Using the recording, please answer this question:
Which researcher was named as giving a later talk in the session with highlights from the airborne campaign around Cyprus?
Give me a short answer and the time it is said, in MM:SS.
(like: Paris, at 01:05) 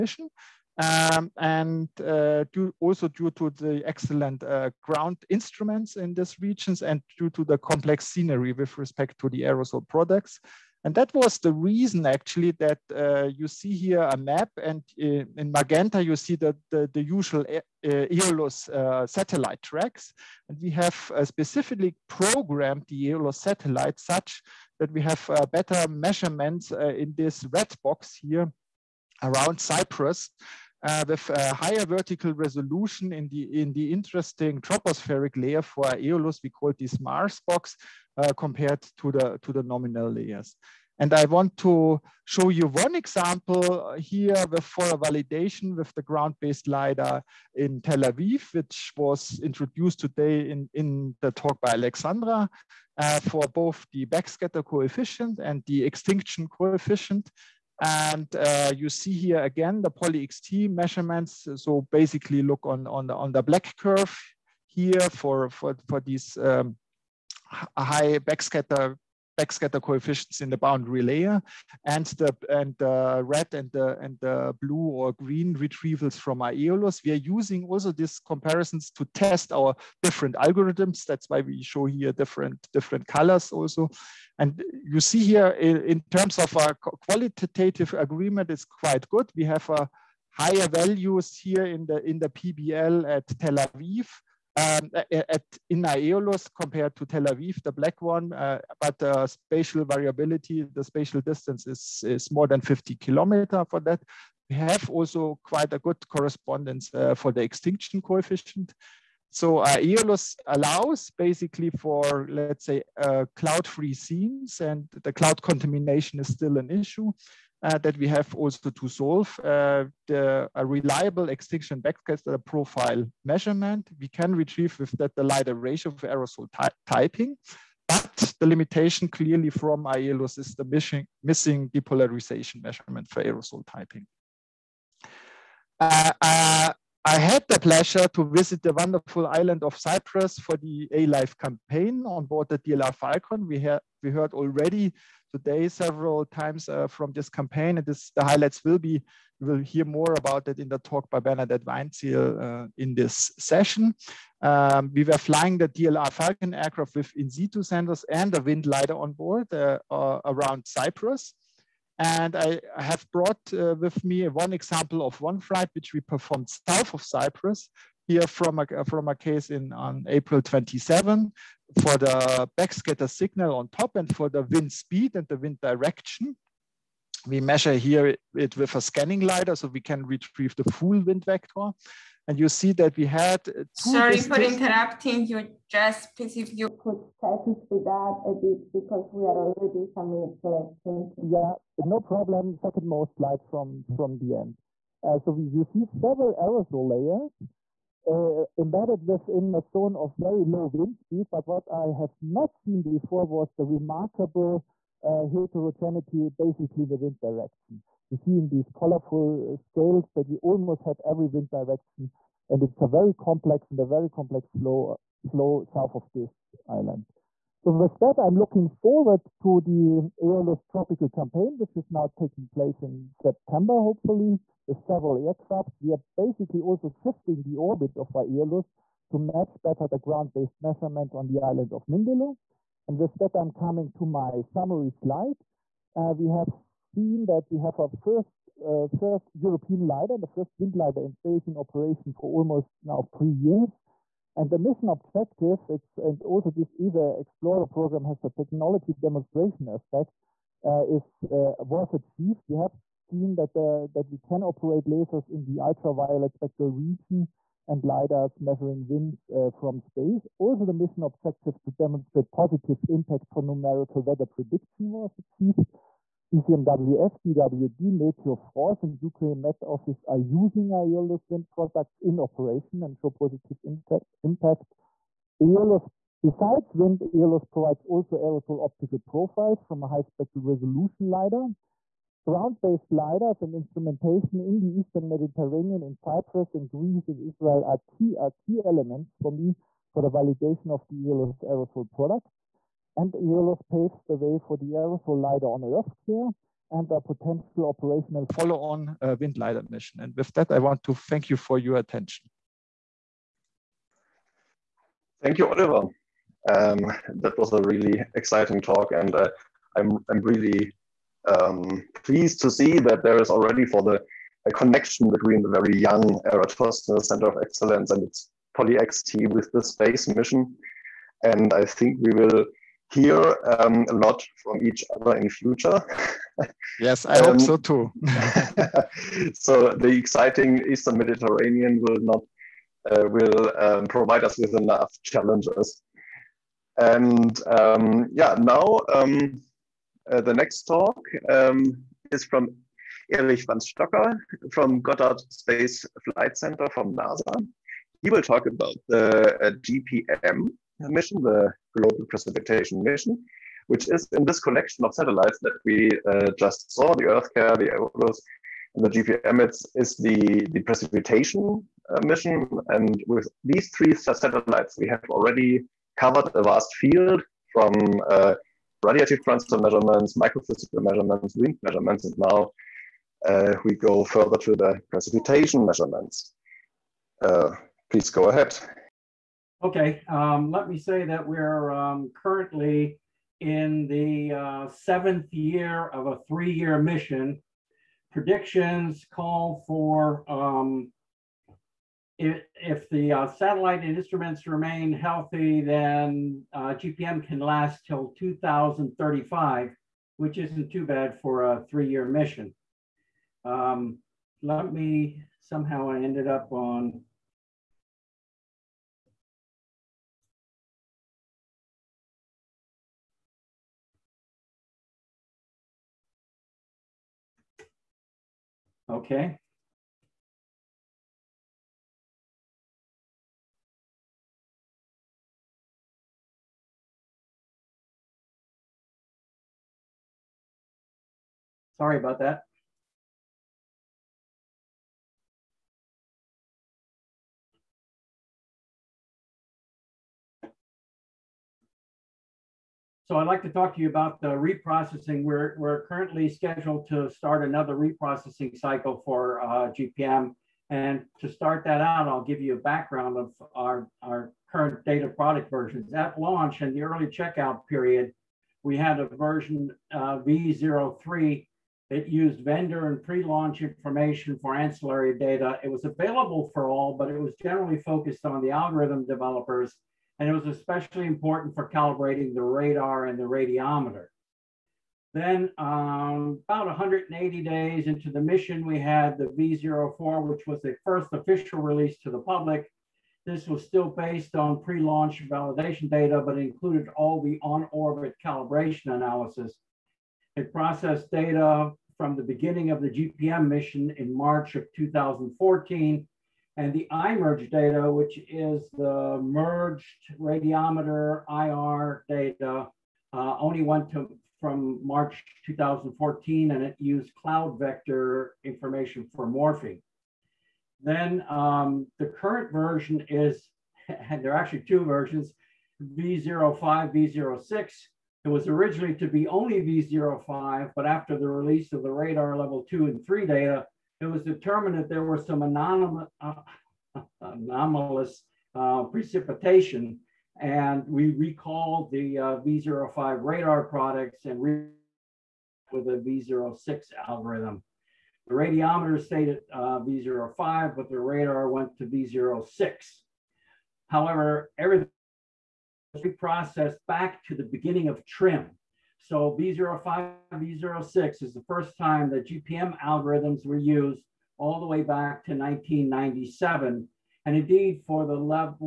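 Bernadette Weinzierl, at 02:31.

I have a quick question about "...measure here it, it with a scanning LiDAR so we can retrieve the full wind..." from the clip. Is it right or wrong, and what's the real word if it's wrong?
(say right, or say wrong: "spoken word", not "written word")
right.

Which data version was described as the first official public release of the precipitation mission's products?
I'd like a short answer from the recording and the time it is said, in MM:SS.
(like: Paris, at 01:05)
V04, at 07:59.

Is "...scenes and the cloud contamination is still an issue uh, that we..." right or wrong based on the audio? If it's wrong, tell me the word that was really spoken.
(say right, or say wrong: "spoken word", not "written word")
right.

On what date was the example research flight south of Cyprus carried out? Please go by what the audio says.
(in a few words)
April 27.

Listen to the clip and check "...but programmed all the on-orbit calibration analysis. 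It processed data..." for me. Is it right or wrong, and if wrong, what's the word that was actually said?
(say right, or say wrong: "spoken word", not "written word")
wrong: "included", not "programmed".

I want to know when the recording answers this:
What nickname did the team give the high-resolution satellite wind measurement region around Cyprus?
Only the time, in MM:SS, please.
00:37.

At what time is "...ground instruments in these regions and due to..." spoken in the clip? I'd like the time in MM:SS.
00:04.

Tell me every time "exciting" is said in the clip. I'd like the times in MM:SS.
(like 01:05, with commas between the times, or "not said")
05:08, 05:29.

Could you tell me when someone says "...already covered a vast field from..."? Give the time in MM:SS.
06:05.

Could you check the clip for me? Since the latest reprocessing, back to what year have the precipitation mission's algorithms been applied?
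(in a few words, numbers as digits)
1997.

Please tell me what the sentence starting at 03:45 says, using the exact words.
We are basically also shifting the orbit of Aeolus to match better the ground-based measurements on the island of Mindelo.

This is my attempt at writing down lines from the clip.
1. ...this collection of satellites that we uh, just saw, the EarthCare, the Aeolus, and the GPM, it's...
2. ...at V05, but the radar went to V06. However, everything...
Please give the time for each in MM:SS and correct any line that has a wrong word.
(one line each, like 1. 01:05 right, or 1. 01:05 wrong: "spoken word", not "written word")
1. 05:54 right
2. 08:59 right.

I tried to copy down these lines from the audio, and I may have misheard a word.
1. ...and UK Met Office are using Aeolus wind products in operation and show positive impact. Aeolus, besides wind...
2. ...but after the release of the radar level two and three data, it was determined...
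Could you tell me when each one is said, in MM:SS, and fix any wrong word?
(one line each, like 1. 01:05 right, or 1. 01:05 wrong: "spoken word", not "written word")
1. 04:28 right
2. 08:40 right.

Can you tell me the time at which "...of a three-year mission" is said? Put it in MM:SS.
06:25.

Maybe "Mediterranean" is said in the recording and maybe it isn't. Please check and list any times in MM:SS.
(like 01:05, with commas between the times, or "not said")
04:45, 05:30.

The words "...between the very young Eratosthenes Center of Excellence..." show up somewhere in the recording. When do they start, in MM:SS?
05:15.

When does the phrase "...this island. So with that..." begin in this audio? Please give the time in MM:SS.
03:36.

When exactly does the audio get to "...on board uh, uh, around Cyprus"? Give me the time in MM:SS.
02:38.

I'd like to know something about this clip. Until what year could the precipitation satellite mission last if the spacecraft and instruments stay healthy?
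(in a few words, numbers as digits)
2035.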